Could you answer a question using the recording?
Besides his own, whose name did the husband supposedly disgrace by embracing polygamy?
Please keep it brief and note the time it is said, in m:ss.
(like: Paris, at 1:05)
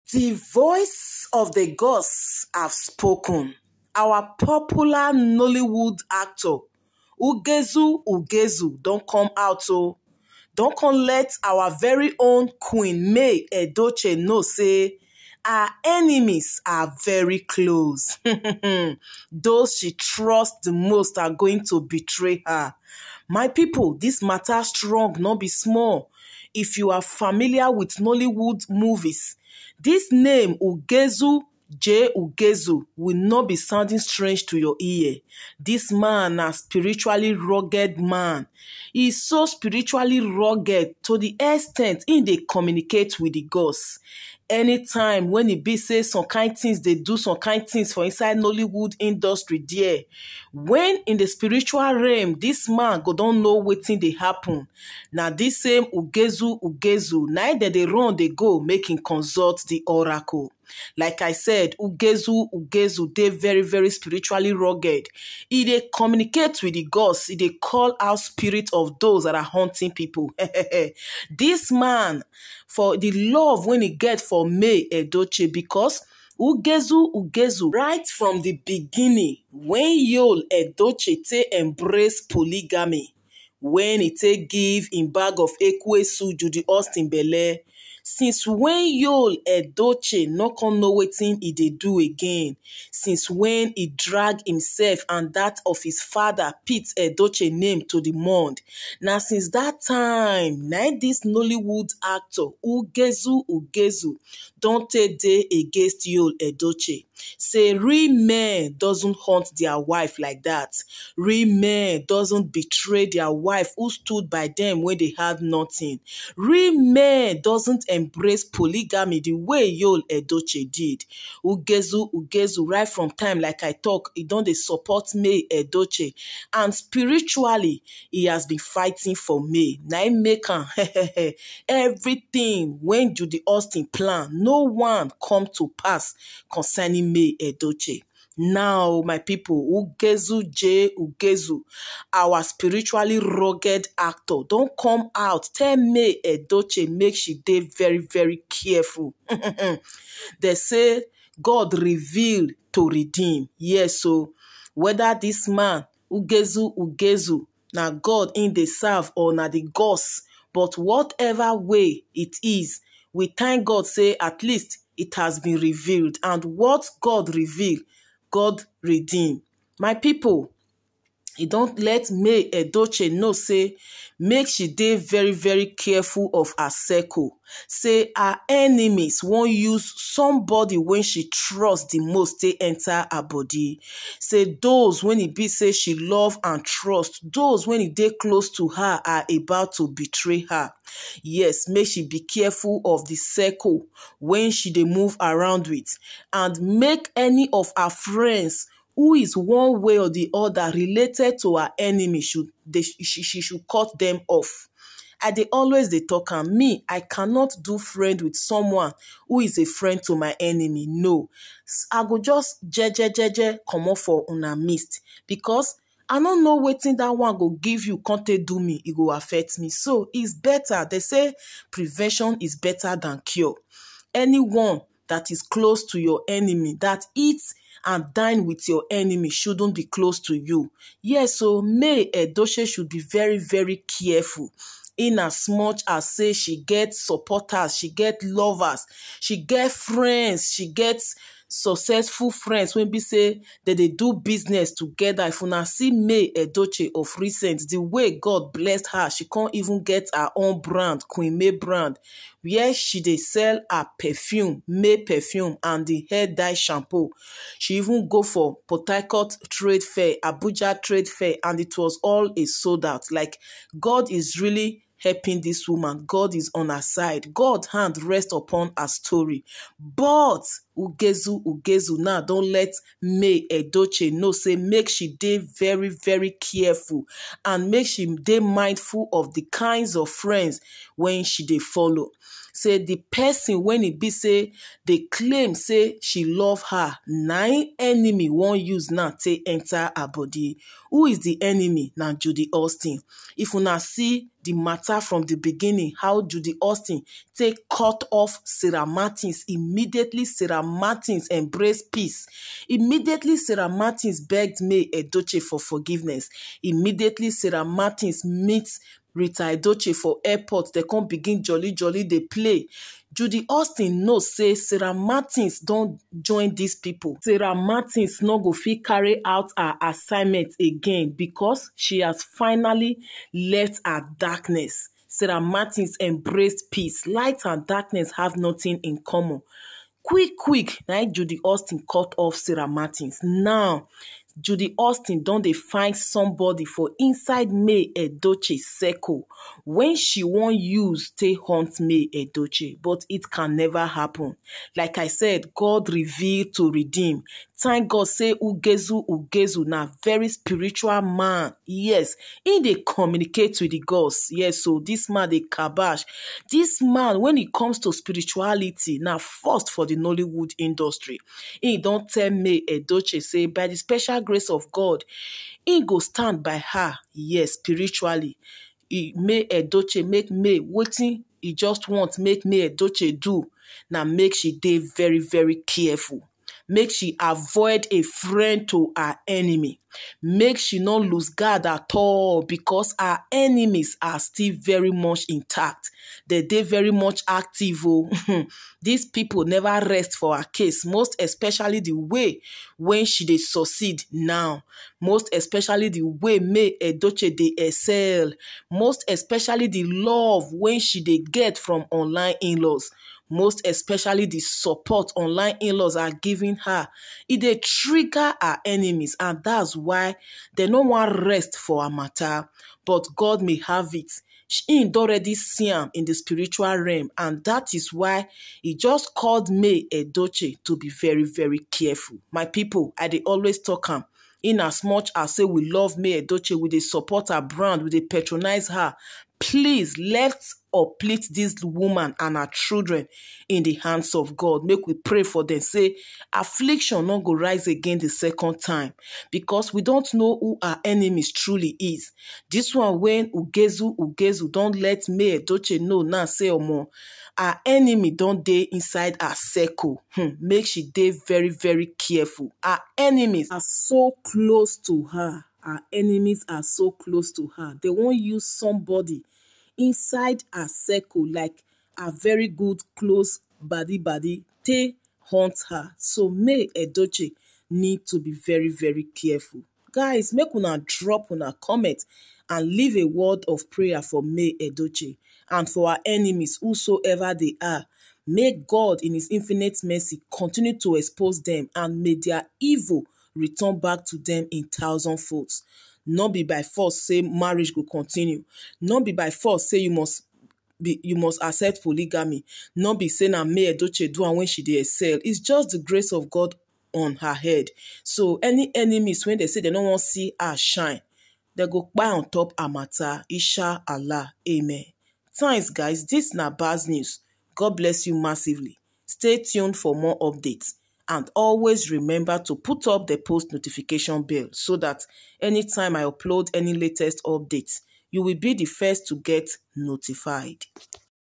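Pete Edochie, at 1:36.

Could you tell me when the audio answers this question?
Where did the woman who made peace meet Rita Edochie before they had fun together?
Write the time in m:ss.
5:10.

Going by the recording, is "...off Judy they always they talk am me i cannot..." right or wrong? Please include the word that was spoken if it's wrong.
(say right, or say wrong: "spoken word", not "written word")
wrong: "And", not "Judy".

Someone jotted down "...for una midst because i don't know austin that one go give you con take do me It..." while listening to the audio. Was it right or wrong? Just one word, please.
wrong.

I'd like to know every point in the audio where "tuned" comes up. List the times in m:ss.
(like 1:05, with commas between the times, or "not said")
8:29.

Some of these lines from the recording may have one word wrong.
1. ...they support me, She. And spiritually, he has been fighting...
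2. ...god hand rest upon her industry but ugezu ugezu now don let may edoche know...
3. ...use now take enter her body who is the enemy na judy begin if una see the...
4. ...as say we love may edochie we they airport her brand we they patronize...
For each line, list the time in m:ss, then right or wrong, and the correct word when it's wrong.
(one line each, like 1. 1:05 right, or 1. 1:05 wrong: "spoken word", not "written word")
1. 2:04 wrong: "Edochie", not "She"
2. 4:27 wrong: "story", not "industry"
3. 4:48 wrong: "austin", not "begin"
4. 7:05 wrong: "support", not "airport".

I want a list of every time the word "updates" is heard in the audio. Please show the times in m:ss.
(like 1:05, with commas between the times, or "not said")
8:30, 8:37.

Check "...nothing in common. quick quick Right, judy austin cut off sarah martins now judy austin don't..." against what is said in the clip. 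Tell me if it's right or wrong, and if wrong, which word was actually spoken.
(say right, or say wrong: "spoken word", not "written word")
right.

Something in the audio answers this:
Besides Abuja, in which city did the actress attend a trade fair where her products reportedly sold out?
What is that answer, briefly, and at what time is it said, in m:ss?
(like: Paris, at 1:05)
Port Harcourt, at 4:18.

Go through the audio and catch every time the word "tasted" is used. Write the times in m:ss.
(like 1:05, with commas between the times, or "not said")
not said.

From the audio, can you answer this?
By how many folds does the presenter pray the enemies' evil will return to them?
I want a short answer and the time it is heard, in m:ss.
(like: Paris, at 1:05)
1000, at 8:04.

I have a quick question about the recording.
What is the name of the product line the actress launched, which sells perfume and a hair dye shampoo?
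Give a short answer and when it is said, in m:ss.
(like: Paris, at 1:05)
Queen May brand, at 4:11.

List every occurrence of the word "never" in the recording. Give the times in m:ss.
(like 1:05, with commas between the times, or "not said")
5:43, 6:29.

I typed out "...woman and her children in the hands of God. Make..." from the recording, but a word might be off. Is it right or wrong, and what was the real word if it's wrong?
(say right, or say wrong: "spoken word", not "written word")
right.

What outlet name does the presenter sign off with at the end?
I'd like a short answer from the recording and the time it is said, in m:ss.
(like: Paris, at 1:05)
Baz News, at 8:26.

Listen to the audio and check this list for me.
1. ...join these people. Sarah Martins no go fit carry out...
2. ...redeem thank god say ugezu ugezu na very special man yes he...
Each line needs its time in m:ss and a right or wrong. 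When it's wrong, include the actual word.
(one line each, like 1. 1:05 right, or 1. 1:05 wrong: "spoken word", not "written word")
1. 5:16 right
2. 5:46 wrong: "spiritual", not "special".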